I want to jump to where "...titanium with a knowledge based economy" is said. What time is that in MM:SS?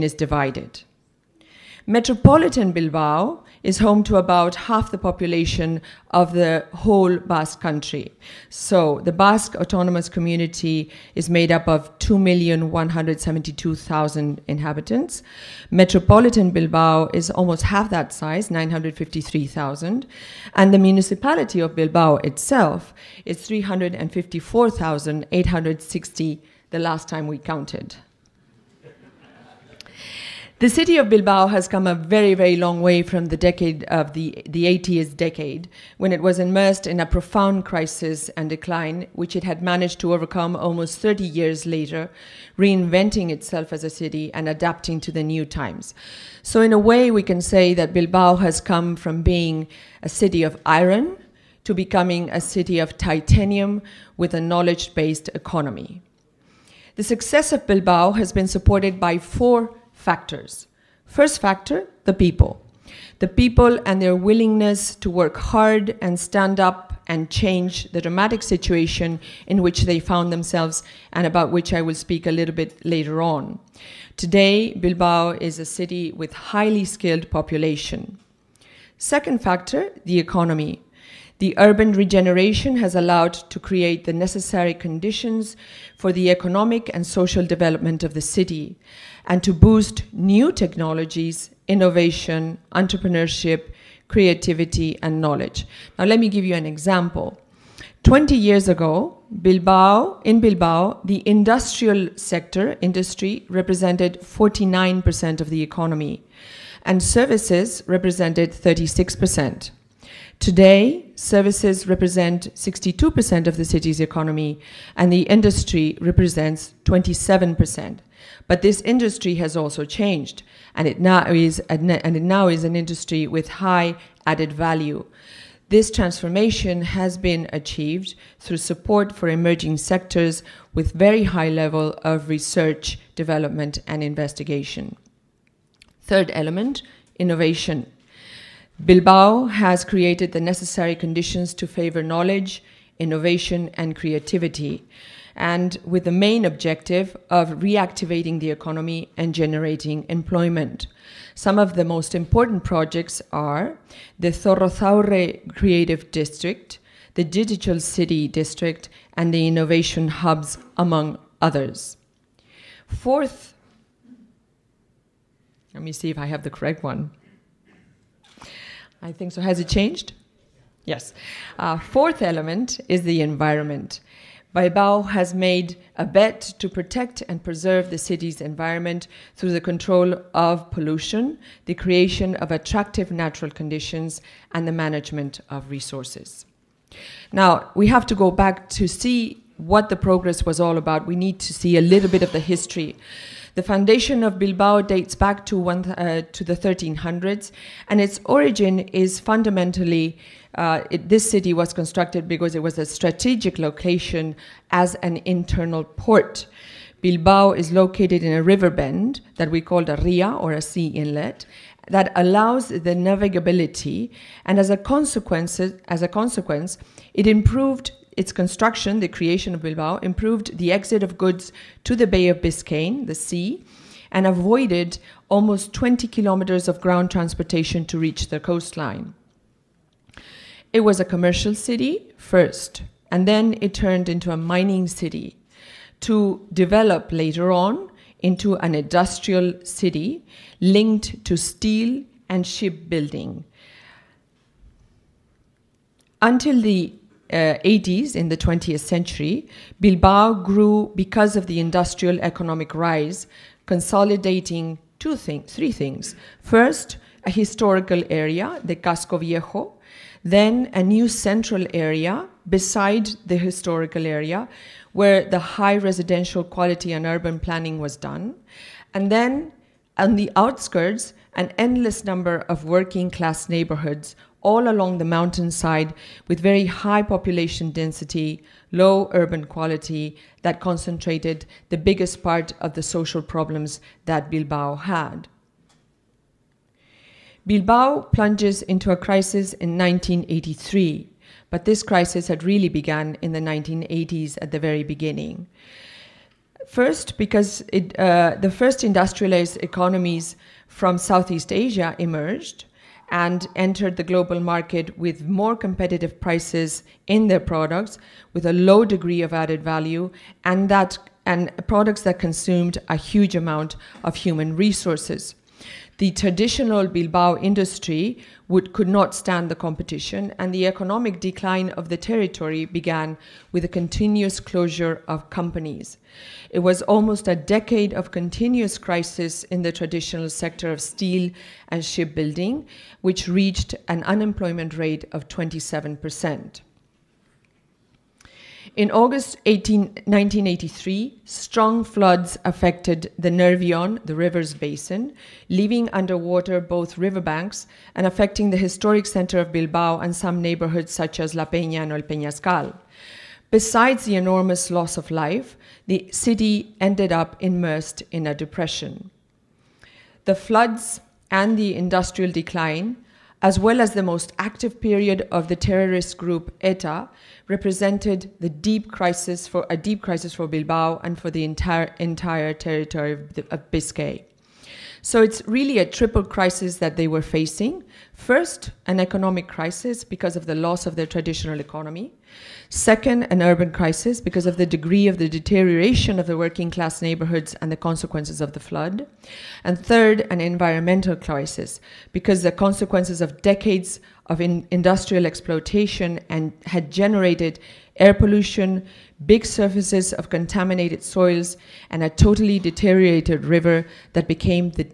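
00:52.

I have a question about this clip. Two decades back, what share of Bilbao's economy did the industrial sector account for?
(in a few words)
49%.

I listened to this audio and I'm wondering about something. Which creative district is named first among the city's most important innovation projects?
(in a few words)
Zorrozaurre Creative District.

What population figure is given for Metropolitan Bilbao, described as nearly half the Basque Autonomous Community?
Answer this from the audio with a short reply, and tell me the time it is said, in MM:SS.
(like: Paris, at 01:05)
953,000, at 00:18.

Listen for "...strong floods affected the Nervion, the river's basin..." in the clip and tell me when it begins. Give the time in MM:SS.
05:41.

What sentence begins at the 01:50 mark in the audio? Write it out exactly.
Today, services represent 62% of the city's economy and the industry represents 27%.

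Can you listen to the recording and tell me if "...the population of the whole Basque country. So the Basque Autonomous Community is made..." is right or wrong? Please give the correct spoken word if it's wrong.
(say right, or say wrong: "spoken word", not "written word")
right.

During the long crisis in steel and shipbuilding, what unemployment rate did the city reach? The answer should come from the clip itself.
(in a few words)
27%.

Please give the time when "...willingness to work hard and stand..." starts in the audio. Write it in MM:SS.
01:04.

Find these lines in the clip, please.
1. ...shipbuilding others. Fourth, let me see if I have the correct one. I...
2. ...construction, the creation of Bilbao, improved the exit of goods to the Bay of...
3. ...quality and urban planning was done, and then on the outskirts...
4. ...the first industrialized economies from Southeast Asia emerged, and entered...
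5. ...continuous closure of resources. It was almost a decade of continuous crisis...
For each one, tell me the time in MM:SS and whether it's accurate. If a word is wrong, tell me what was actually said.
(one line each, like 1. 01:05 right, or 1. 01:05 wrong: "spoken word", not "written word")
1. 02:40 wrong: "among", not "shipbuilding"
2. 03:38 right
3. 04:26 right
4. 04:58 right
5. 05:23 wrong: "companies", not "resources".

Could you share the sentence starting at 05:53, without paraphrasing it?
Besides the enormous loss of life, the city ended up immersed in a depression.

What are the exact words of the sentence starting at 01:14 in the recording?
Today, Bilbao is a city with highly skilled population.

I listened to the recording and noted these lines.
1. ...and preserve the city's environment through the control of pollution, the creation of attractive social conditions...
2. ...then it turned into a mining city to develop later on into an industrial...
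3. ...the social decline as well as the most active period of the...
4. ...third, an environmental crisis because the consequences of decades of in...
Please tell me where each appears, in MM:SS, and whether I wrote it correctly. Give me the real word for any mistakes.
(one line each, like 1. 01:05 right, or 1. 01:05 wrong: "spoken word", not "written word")
1. 02:57 wrong: "natural", not "social"
2. 03:53 right
3. 06:01 wrong: "industrial", not "social"
4. 06:29 right.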